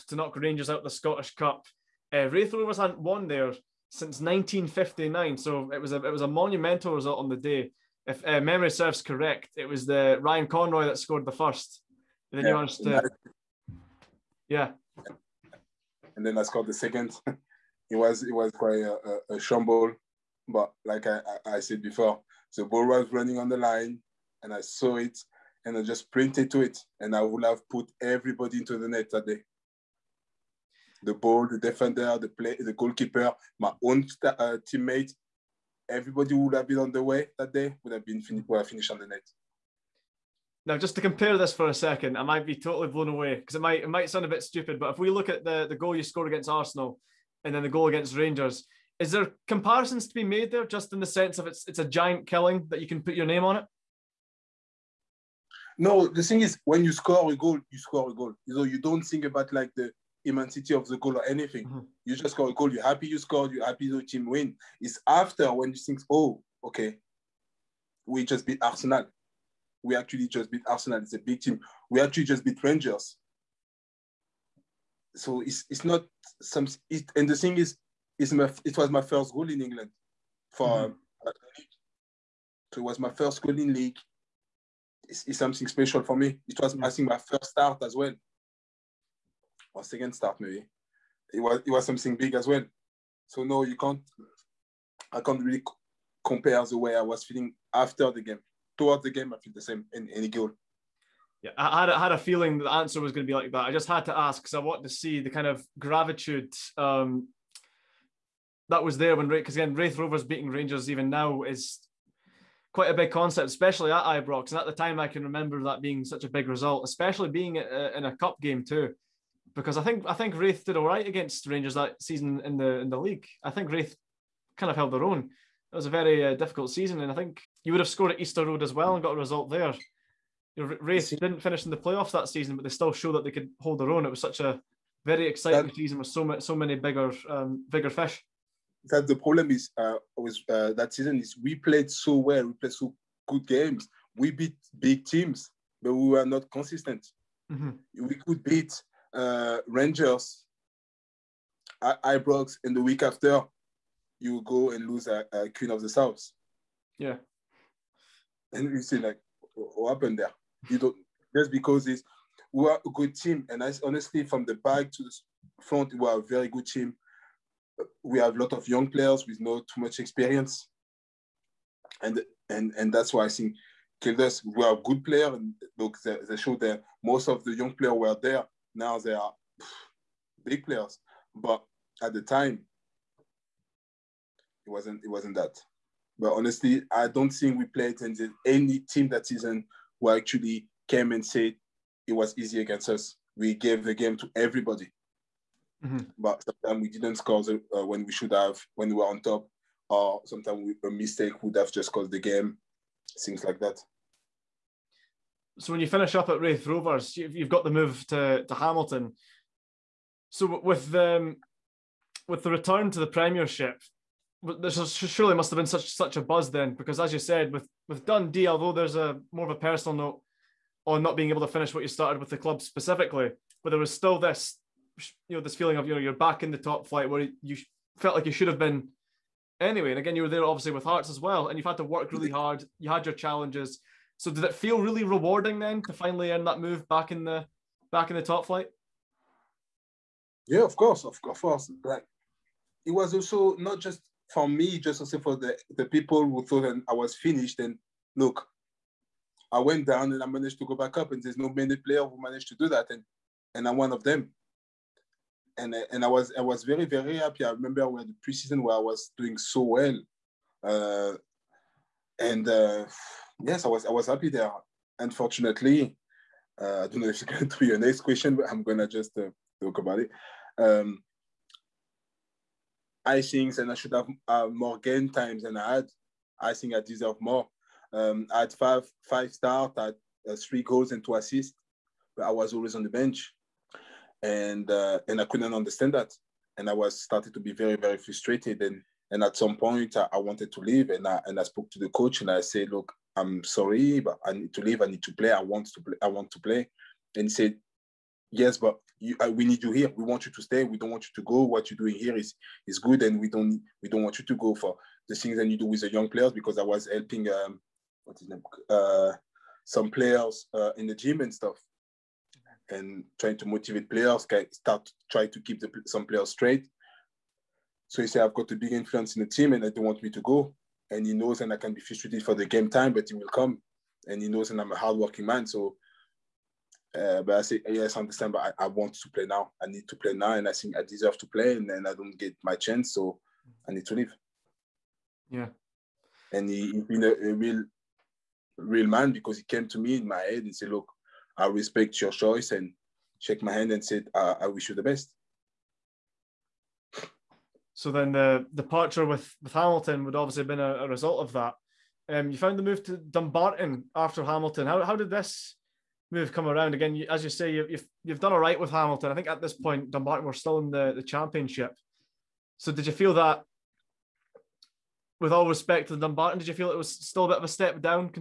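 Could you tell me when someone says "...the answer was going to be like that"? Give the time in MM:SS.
01:42.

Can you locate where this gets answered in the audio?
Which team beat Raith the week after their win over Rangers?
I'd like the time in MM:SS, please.
02:35.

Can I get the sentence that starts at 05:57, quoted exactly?
as you say, you, you've you've done all right with Hamilton.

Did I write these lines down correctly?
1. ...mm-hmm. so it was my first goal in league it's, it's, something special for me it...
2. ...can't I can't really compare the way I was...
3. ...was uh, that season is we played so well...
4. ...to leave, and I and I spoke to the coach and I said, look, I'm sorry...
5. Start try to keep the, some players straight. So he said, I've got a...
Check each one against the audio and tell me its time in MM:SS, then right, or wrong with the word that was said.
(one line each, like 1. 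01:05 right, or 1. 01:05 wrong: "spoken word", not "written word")
1. 01:20 right
2. 01:33 right
3. 02:20 right
4. 04:50 right
5. 05:14 right.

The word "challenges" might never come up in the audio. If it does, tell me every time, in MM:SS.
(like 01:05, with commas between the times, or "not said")
03:53.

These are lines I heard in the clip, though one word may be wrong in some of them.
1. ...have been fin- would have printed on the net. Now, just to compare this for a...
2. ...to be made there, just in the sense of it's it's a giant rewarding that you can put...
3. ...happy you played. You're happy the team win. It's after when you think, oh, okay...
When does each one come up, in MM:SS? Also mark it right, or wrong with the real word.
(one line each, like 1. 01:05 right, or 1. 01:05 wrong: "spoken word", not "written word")
1. 00:37 wrong: "finished", not "printed"
2. 00:50 wrong: "killing", not "rewarding"
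3. 01:02 wrong: "scored", not "played".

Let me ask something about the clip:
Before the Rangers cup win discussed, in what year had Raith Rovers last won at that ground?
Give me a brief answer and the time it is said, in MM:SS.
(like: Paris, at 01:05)
1959, at 00:04.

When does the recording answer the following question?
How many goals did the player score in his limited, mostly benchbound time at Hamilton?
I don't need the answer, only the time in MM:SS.
04:40.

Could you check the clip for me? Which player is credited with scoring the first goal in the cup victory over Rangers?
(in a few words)
Ryan Conroy.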